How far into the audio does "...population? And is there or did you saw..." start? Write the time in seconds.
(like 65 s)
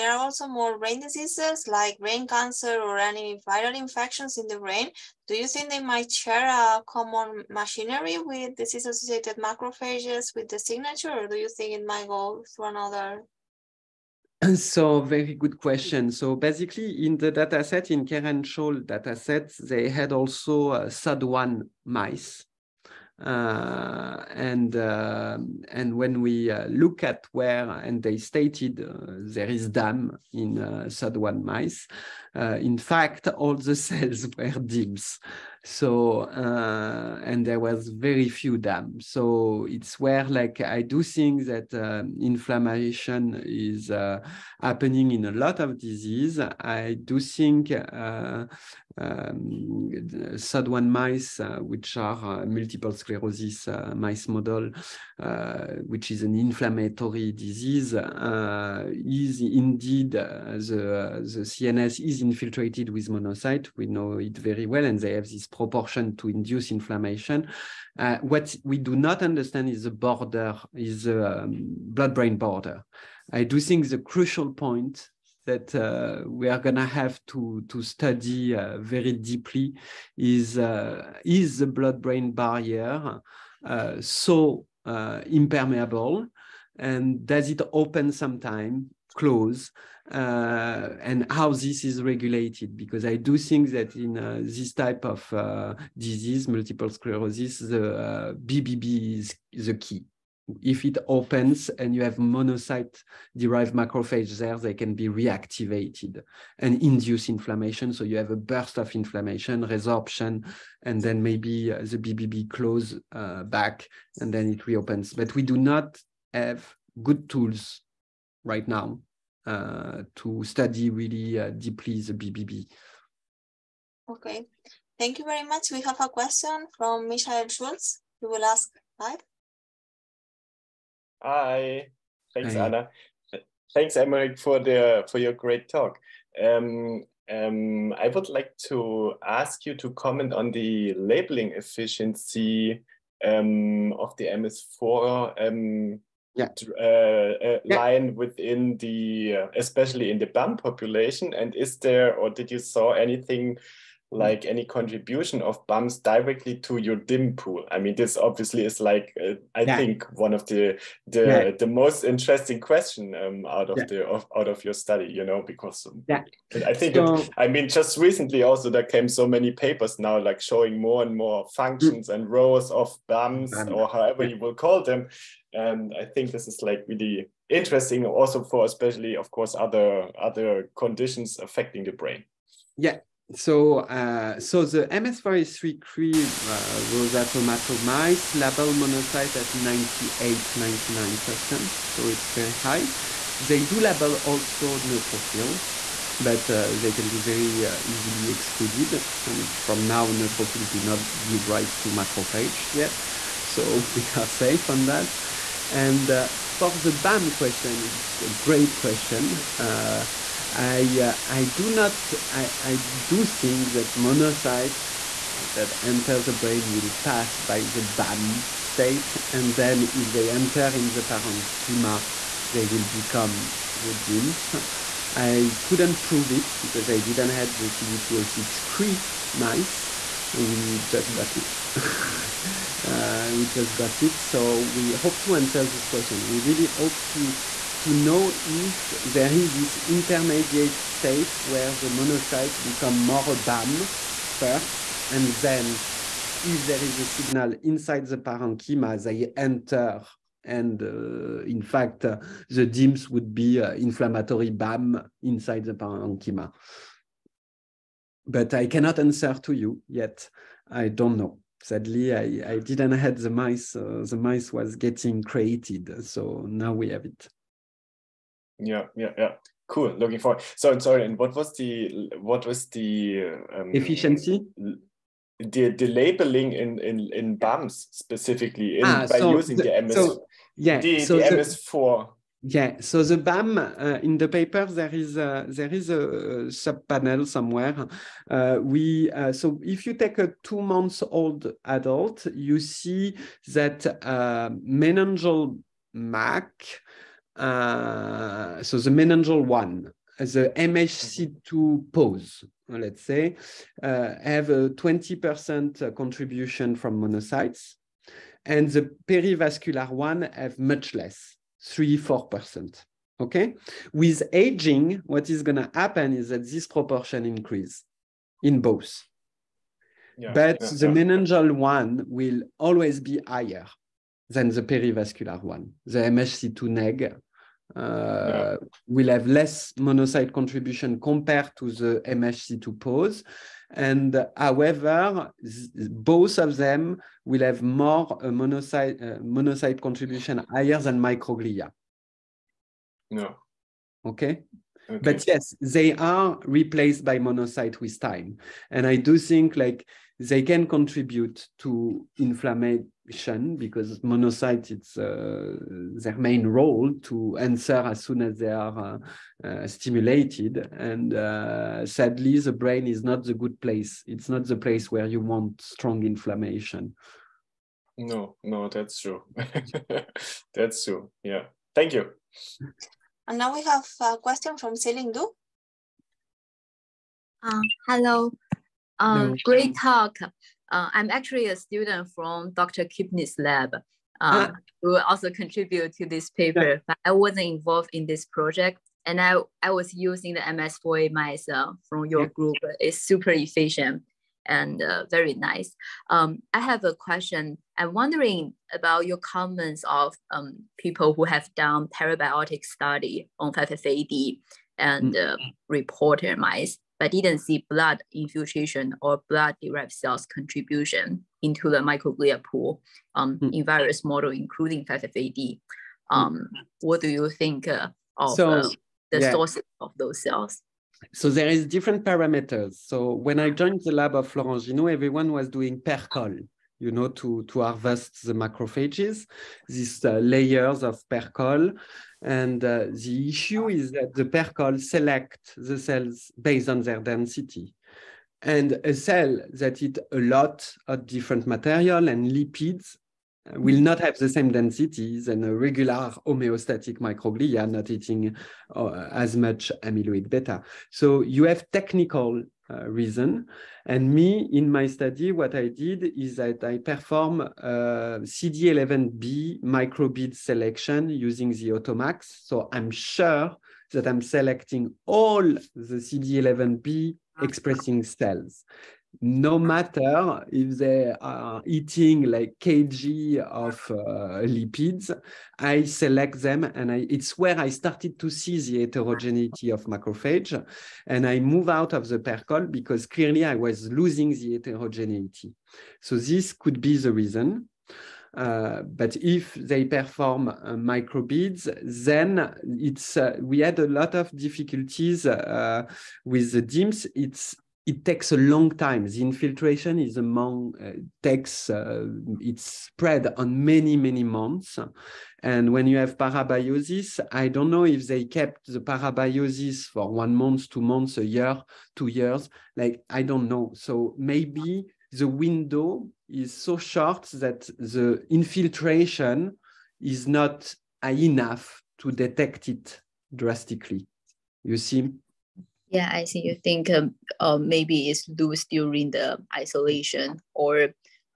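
150 s.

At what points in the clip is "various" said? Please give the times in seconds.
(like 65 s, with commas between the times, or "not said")
413 s.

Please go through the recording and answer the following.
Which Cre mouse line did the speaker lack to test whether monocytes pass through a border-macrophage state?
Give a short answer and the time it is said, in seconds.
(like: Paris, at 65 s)
CD206 Cre, at 227 s.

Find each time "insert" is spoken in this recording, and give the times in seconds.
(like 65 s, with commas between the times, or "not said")
not said.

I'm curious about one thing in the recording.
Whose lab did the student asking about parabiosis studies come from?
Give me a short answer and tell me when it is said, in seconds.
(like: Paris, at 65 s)
Dr. Kipnis, at 382 s.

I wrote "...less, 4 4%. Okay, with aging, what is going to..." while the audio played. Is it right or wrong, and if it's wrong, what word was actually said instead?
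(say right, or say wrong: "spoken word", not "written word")
wrong: "3", not "4".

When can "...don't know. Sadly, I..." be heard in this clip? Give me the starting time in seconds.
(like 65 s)
260 s.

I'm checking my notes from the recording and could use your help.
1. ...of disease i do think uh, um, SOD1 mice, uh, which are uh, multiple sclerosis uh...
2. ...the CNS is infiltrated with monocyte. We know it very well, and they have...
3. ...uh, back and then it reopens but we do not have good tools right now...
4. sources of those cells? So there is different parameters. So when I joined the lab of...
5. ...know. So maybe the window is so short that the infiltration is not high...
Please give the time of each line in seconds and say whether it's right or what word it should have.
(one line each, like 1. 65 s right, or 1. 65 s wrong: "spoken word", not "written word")
1. 45 s right
2. 61 s right
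3. 113 s right
4. 419 s right
5. 513 s right.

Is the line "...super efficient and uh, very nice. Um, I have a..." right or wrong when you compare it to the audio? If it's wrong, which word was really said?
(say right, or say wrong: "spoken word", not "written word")
right.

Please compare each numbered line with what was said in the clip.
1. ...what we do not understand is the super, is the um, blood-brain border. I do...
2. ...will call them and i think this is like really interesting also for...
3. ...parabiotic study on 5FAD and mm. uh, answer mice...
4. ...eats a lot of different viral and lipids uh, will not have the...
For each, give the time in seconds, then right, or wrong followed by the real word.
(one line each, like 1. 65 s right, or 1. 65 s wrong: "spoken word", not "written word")
1. 68 s wrong: "border", not "super"
2. 174 s right
3. 401 s wrong: "reporter", not "answer"
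4. 439 s wrong: "material", not "viral".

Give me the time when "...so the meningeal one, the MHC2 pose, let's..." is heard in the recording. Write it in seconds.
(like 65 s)
298 s.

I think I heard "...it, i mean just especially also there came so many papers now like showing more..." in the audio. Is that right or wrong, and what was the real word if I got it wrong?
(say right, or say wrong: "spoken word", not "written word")
wrong: "recently", not "especially".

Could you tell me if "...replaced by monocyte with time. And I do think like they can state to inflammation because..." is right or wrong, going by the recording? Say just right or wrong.
wrong.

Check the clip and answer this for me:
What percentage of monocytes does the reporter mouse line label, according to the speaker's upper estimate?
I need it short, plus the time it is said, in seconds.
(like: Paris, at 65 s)
99%, at 190 s.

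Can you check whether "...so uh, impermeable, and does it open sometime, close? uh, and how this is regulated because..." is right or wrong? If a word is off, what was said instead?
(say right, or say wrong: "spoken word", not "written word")
right.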